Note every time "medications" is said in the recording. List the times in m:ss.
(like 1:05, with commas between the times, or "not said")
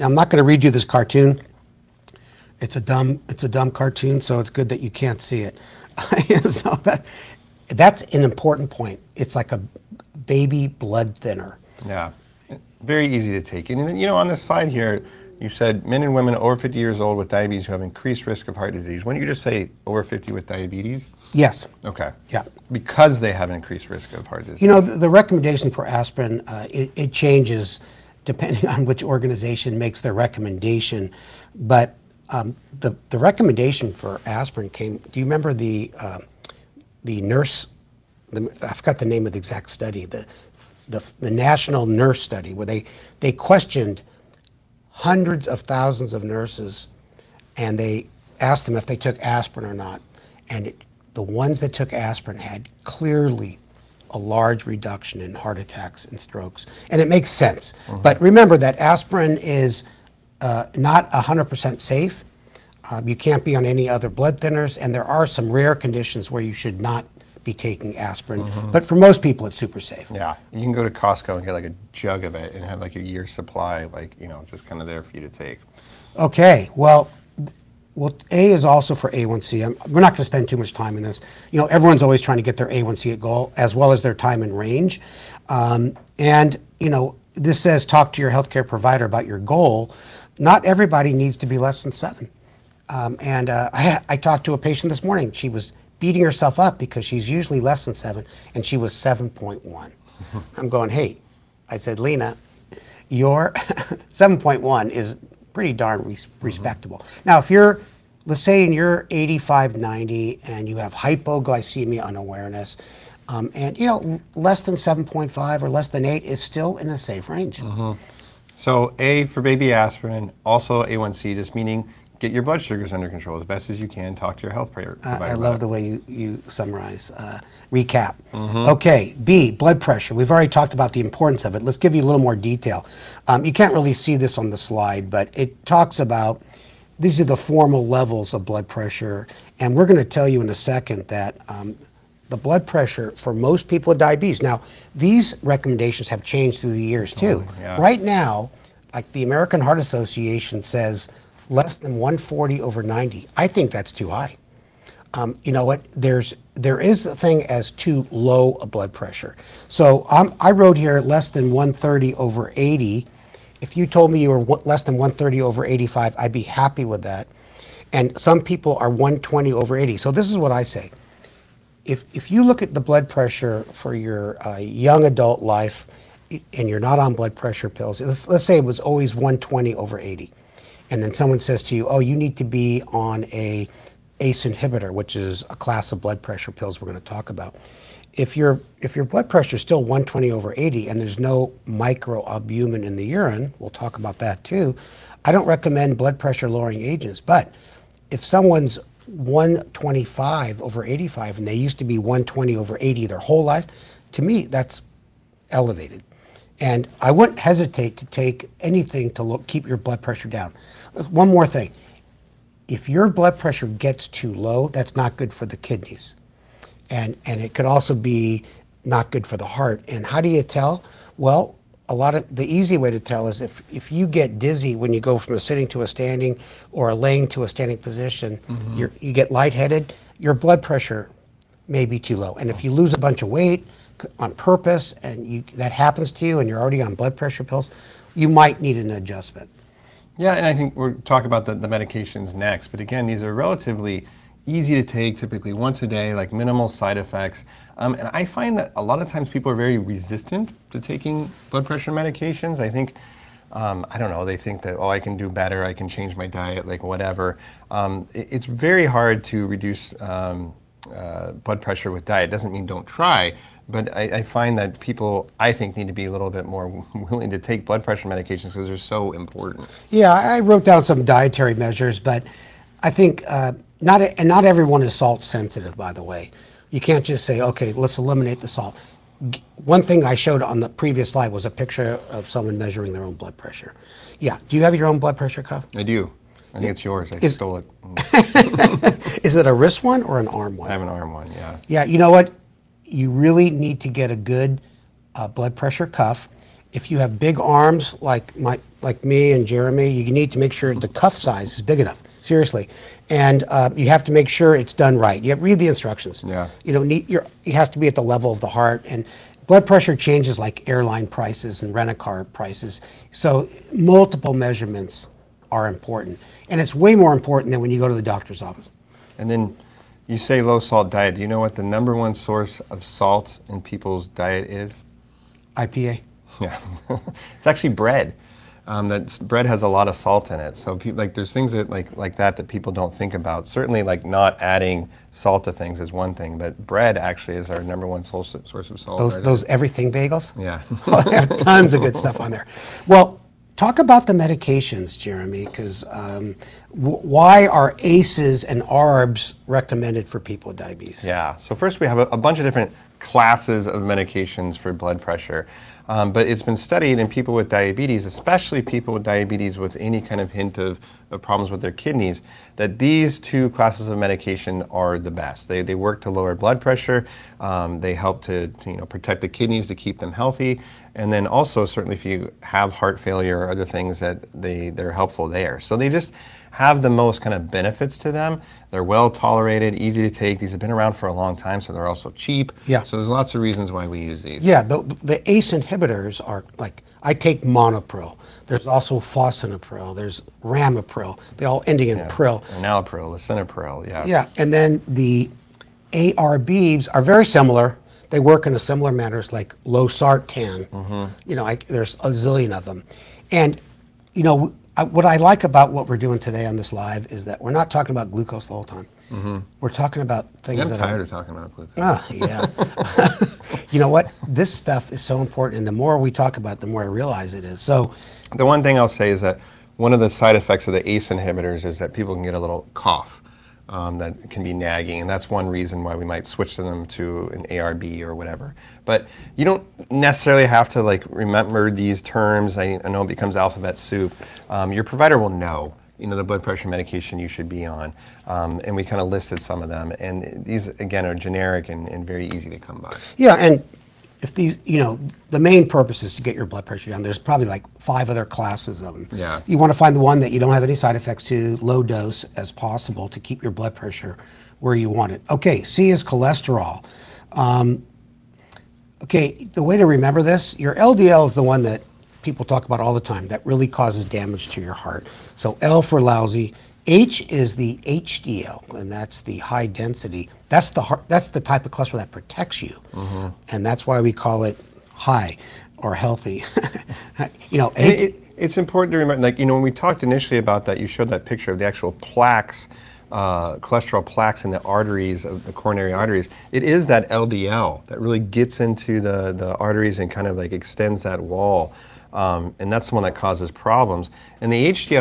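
4:01, 4:11, 4:28, 5:44, 5:53, 6:03, 7:16.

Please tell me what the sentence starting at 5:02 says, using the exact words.
Seriously, and uh, you have to make sure it's done right.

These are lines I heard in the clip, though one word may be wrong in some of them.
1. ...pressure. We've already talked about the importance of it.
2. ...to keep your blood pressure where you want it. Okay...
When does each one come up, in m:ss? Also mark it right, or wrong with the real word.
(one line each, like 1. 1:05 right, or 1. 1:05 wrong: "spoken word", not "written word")
1. 2:09 right
2. 7:33 right.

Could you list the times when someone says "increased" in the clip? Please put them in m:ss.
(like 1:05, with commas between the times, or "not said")
0:17, 0:23.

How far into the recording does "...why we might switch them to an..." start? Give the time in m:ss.
7:05.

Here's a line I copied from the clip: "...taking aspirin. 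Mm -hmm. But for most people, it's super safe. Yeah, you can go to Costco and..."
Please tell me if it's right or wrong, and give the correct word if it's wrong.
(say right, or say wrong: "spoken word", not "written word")
right.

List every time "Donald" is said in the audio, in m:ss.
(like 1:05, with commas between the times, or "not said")
not said.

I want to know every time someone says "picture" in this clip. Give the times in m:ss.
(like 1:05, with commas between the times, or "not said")
4:41, 8:01.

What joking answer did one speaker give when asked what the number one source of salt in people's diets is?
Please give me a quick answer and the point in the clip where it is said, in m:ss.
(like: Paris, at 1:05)
IPA, at 5:25.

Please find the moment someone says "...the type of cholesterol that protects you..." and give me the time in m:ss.
7:51.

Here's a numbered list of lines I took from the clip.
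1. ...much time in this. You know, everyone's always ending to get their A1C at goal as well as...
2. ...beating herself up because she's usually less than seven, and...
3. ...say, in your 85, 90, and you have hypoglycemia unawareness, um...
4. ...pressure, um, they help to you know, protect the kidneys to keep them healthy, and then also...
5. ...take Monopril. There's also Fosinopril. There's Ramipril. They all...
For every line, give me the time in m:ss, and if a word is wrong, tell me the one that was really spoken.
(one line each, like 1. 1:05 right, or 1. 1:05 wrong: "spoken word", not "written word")
1. 1:20 wrong: "trying", not "ending"
2. 1:35 right
3. 1:48 right
4. 6:06 right
5. 6:27 right.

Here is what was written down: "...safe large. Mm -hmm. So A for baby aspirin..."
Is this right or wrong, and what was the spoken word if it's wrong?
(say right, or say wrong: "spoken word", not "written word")
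wrong: "range", not "large".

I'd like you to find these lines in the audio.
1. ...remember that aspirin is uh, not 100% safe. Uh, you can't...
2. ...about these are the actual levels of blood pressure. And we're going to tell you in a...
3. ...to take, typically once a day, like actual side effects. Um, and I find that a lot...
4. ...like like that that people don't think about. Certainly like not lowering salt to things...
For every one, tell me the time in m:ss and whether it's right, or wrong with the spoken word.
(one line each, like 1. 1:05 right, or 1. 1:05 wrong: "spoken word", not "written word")
1. 0:58 right
2. 2:15 wrong: "formal", not "actual"
3. 4:04 wrong: "minimal", not "actual"
4. 5:31 wrong: "adding", not "lowering".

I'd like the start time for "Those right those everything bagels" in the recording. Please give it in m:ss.
5:38.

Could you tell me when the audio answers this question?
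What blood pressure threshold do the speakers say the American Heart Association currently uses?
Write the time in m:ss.
2:31.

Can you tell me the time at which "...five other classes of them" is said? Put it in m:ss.
7:27.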